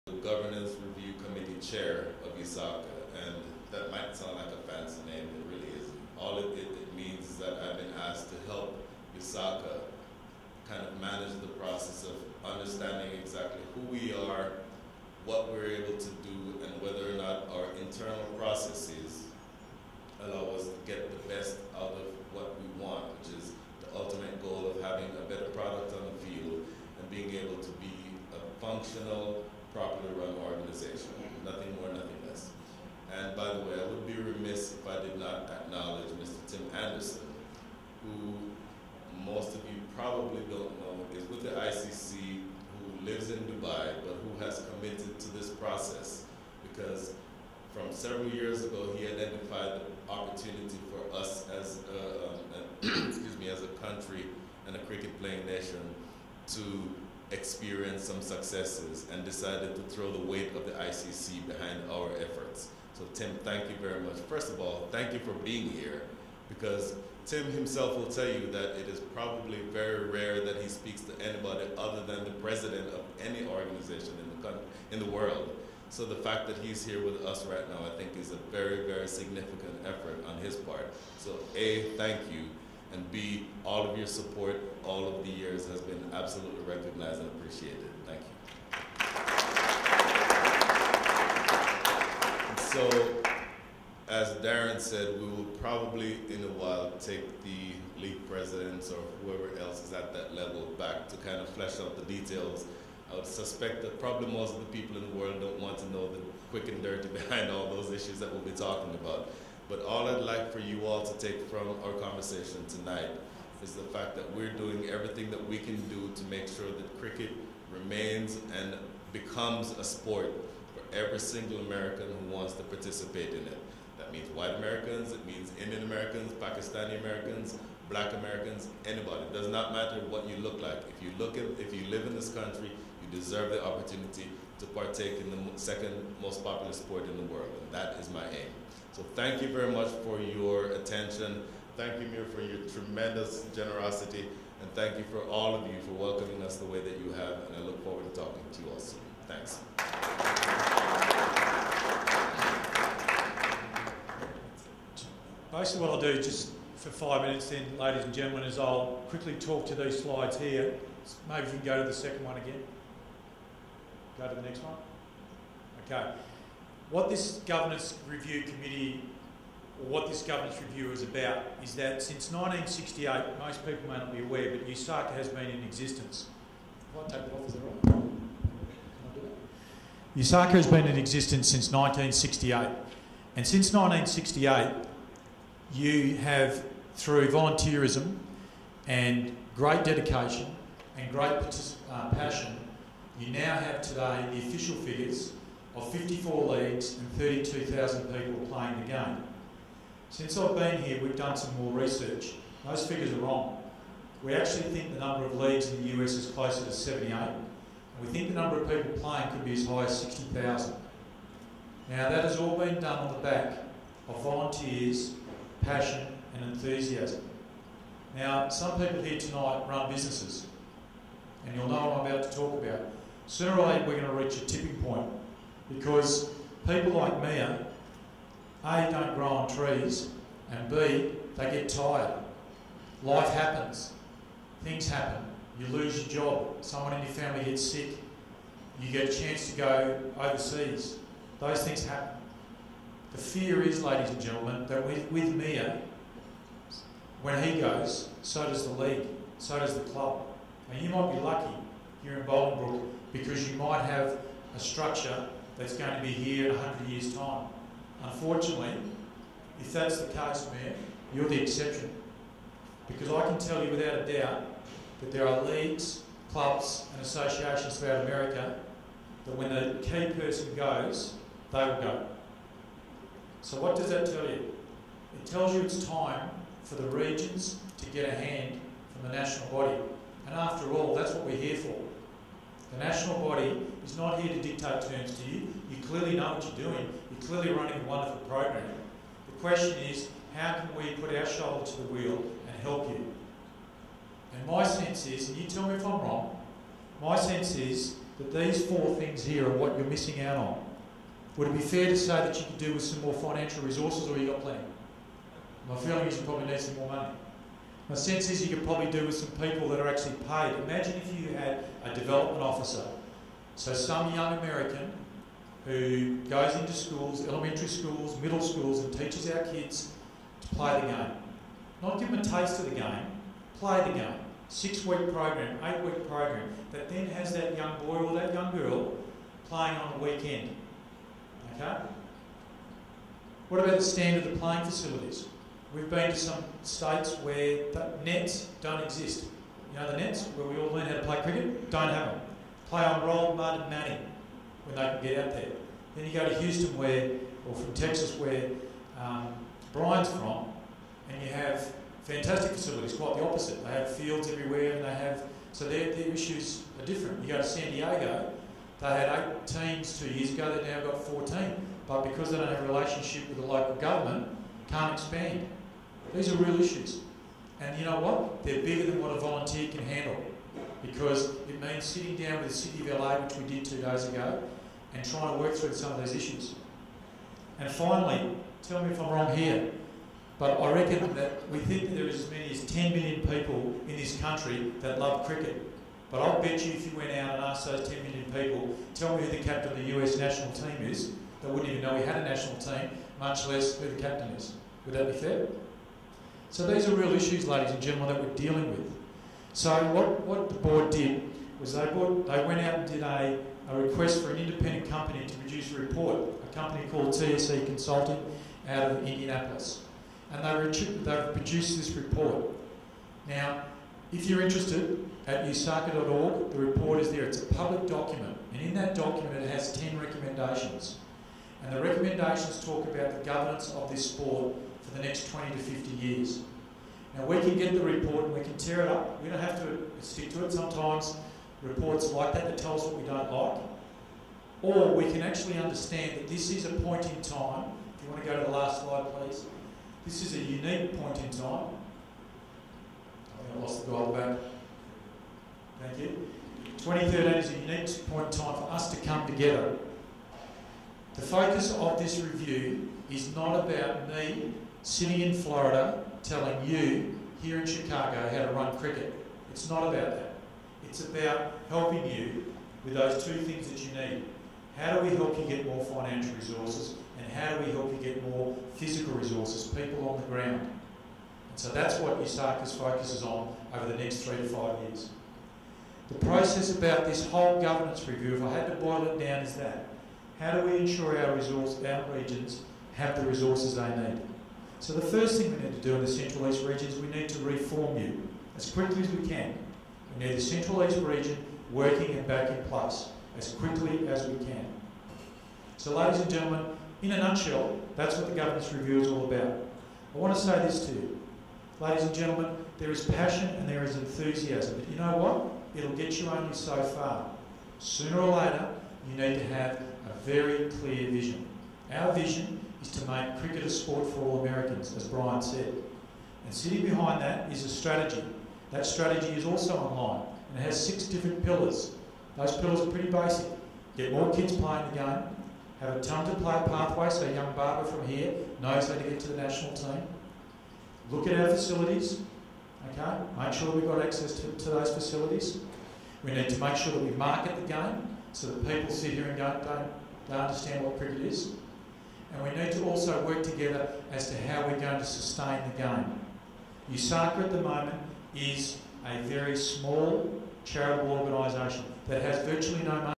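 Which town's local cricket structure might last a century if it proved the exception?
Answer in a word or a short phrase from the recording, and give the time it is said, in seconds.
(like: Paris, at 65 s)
Bolingbrook, at 252 s.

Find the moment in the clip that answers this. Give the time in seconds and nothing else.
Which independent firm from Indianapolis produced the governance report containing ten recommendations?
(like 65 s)
407 s.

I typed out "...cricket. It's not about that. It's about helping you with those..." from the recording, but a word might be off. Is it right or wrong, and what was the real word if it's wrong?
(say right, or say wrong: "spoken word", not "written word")
right.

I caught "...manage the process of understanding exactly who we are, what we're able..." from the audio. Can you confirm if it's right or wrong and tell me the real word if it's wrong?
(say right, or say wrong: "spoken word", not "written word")
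right.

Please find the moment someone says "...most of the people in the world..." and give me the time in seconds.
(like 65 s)
104 s.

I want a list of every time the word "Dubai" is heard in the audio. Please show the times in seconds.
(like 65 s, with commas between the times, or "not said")
43 s.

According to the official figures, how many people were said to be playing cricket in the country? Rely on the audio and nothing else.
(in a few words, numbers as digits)
32,000.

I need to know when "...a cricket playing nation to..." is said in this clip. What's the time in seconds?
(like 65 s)
54 s.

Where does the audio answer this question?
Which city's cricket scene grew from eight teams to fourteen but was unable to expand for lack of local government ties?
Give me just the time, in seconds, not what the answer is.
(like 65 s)
357 s.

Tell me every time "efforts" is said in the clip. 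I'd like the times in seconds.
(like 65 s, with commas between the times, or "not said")
62 s, 79 s.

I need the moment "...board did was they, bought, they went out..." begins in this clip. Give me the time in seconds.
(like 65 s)
400 s.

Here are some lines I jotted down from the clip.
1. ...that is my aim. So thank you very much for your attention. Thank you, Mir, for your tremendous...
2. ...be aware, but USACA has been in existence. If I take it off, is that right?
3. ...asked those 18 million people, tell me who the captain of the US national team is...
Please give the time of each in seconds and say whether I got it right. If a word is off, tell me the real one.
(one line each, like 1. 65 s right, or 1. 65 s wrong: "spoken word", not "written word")
1. 137 s right
2. 174 s right
3. 387 s wrong: "10", not "18".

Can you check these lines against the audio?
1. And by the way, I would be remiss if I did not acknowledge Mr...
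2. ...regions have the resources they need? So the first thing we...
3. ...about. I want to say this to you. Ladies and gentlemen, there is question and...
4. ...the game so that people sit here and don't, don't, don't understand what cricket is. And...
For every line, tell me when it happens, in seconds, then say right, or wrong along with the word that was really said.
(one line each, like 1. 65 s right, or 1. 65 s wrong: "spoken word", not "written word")
1. 33 s right
2. 482 s right
3. 499 s wrong: "passion", not "question"
4. 537 s right.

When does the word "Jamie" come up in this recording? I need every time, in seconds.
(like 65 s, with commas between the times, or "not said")
not said.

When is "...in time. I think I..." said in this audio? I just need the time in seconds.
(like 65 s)
441 s.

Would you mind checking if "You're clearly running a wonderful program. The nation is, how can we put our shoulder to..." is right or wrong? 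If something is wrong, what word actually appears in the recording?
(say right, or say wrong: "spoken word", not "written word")
wrong: "question", not "nation".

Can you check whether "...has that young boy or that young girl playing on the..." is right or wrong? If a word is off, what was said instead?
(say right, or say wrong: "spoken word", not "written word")
right.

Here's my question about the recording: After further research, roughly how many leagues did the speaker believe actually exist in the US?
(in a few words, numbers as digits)
78.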